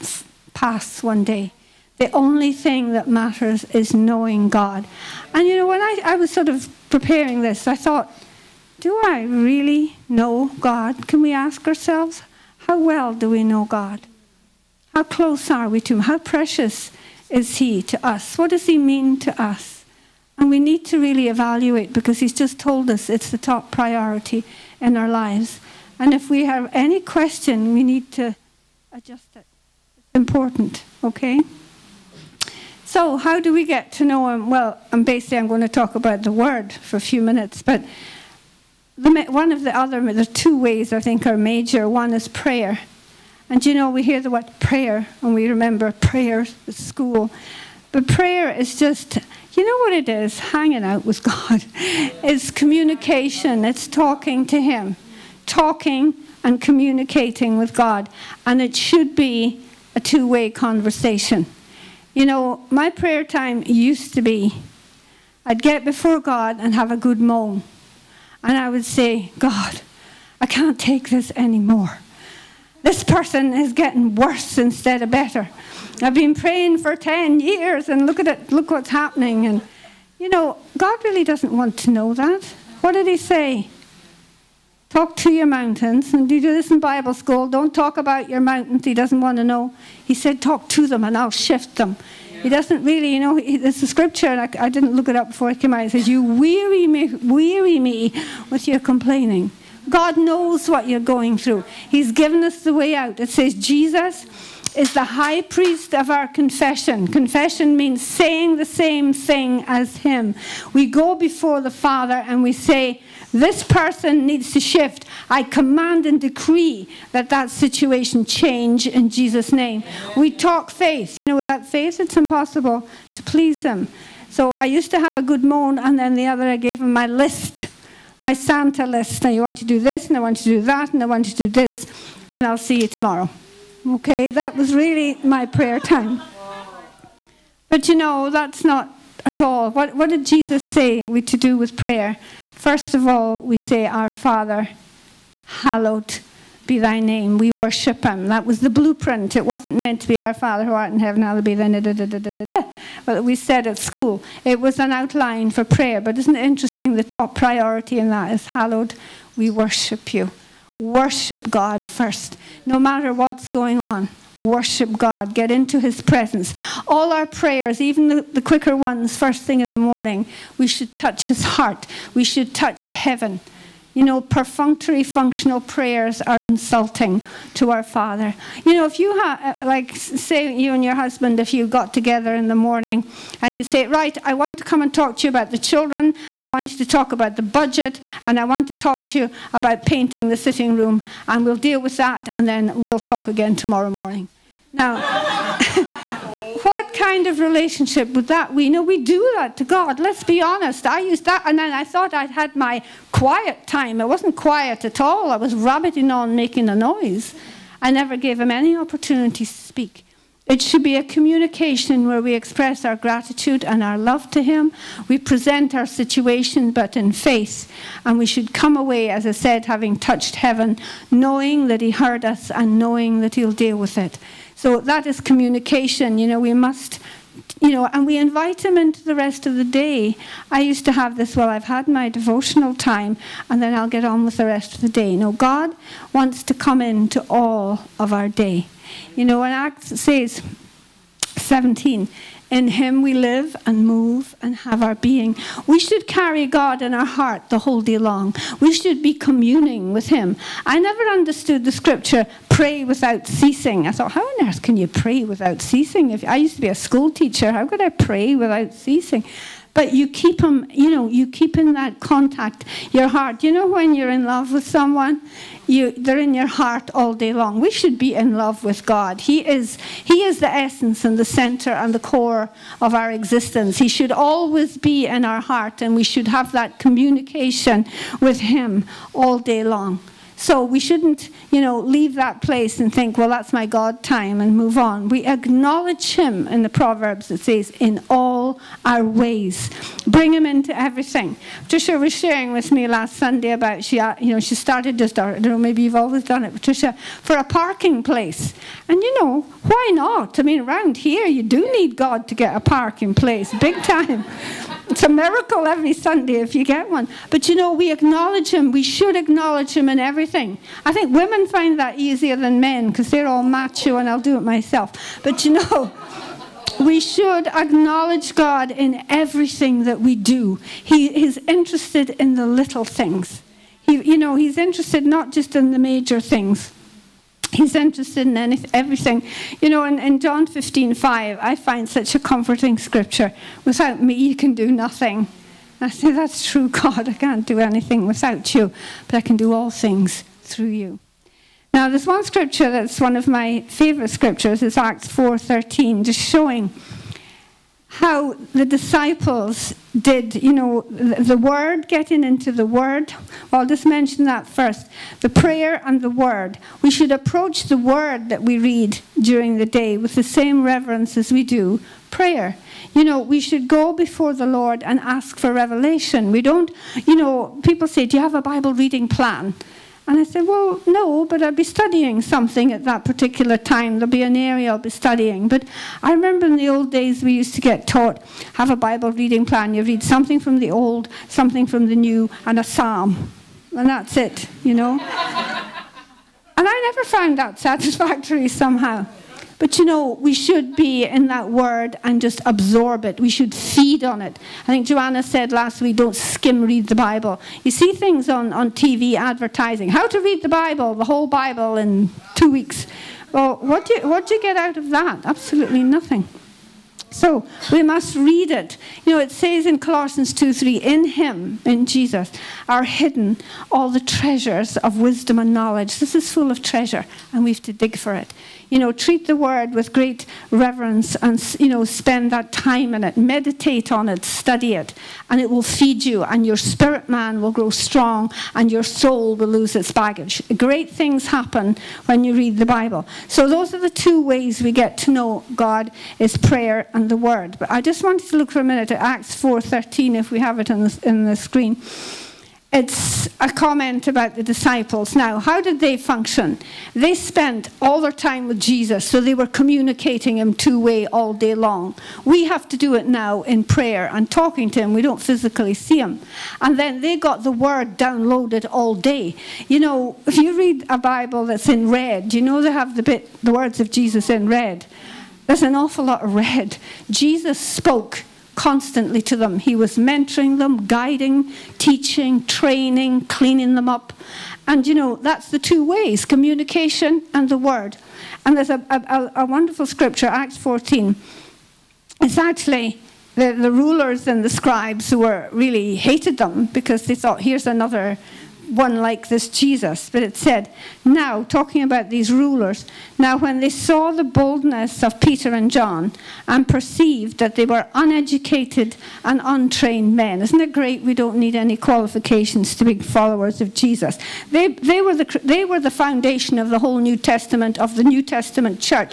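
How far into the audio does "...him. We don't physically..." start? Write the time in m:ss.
7:34.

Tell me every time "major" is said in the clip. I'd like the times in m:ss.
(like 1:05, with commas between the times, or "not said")
0:41, 5:25.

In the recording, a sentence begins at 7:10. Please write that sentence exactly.
Great things happen when you read the Bible.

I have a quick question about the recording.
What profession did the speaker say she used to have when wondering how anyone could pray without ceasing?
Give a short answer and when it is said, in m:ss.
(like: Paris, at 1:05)
School teacher, at 4:16.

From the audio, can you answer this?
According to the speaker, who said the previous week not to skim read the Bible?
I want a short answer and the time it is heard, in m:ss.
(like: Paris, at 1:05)
Joanna, at 6:34.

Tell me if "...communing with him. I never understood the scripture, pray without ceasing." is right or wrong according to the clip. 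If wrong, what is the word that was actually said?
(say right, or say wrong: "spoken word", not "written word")
right.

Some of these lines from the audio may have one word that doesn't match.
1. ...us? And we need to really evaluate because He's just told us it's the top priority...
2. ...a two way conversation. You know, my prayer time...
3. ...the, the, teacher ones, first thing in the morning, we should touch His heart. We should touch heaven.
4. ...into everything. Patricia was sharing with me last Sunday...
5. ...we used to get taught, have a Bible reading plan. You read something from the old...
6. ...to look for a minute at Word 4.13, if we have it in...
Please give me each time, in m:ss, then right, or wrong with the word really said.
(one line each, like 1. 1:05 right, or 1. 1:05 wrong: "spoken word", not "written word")
1. 0:19 right
2. 0:59 right
3. 2:48 wrong: "quicker", not "teacher"
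4. 4:50 right
5. 6:17 right
6. 7:18 wrong: "Acts", not "Word".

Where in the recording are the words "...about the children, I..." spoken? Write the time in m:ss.
3:05.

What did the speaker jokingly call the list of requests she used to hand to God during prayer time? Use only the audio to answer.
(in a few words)
Santa list.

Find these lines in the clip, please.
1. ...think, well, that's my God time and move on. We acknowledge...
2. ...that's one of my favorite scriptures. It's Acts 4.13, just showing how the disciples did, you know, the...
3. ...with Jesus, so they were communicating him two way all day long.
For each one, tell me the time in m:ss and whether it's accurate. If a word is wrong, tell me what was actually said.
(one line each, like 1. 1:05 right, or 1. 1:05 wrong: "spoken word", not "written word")
1. 4:42 right
2. 5:42 right
3. 7:28 right.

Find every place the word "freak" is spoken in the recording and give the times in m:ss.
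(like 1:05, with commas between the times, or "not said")
not said.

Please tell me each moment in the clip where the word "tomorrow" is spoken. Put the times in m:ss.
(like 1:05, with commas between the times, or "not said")
2:12, 3:13.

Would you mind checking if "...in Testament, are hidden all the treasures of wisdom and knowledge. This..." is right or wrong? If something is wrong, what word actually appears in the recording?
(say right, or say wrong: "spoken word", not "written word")
wrong: "Jesus", not "Testament".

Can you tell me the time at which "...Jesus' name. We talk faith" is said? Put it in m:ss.
1:59.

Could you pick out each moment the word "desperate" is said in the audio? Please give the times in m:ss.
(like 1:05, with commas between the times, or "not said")
not said.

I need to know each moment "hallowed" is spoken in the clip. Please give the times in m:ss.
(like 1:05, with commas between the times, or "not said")
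2:25, 2:31, 2:38.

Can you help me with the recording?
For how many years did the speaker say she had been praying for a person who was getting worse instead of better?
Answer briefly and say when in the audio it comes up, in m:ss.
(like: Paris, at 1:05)
10, at 1:16.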